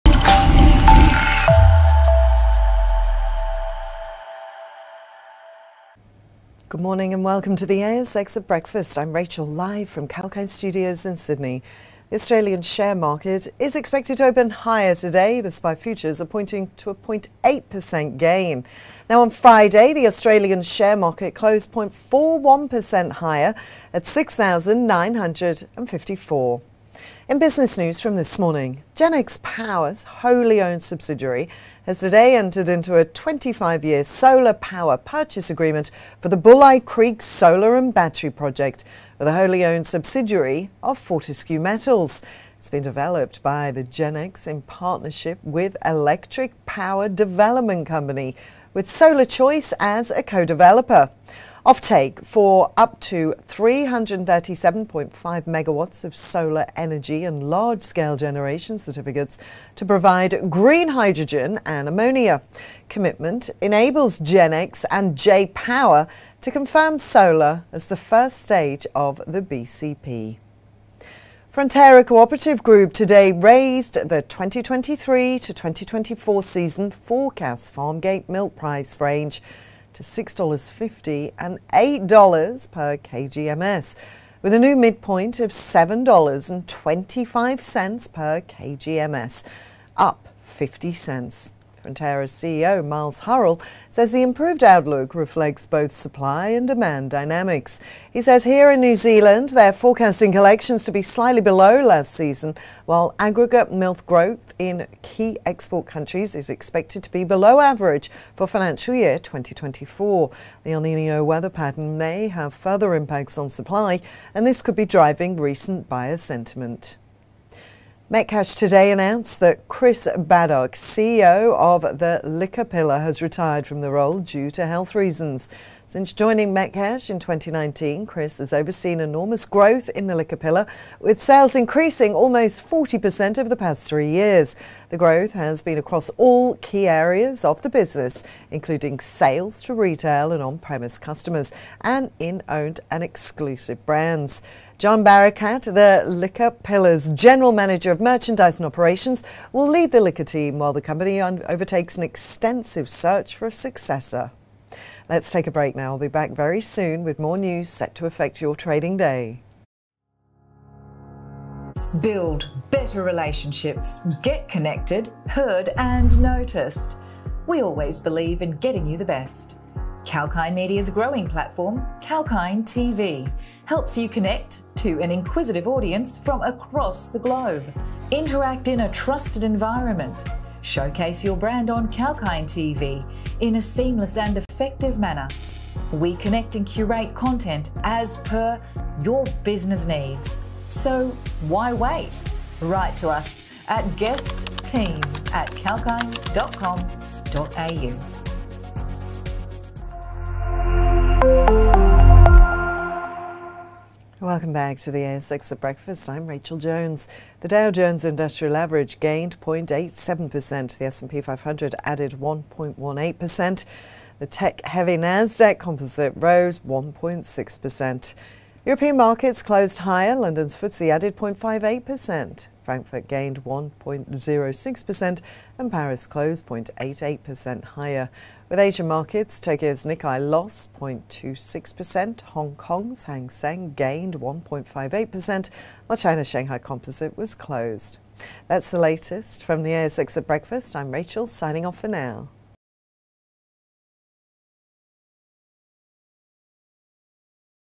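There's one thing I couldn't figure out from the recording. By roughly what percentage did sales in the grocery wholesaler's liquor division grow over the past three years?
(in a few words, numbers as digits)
40%.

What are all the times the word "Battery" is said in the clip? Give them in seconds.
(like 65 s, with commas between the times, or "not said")
37 s.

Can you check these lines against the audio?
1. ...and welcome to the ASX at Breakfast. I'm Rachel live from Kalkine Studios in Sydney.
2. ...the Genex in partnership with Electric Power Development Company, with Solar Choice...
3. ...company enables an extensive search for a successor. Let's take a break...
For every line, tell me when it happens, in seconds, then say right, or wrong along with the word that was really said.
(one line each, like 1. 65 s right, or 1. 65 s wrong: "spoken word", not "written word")
1. 7 s right
2. 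43 s right
3. 150 s wrong: "undertakes", not "enables".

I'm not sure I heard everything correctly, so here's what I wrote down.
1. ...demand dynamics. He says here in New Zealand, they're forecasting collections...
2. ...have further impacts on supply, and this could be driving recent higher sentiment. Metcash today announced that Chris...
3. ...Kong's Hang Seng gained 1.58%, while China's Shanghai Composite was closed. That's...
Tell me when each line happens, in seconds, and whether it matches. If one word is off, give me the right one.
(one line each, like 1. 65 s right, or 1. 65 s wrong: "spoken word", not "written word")
1. 96 s right
2. 112 s wrong: "buyer", not "higher"
3. 232 s right.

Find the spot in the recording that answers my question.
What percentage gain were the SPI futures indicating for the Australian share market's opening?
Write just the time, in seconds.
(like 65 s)
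16 s.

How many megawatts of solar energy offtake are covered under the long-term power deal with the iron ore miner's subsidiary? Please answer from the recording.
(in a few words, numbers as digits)
337.5.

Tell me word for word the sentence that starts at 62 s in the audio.
Commitment enables Genex and J Power to confirm solar as the first stage of the BCP.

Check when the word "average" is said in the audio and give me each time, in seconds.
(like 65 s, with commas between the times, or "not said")
107 s, 208 s.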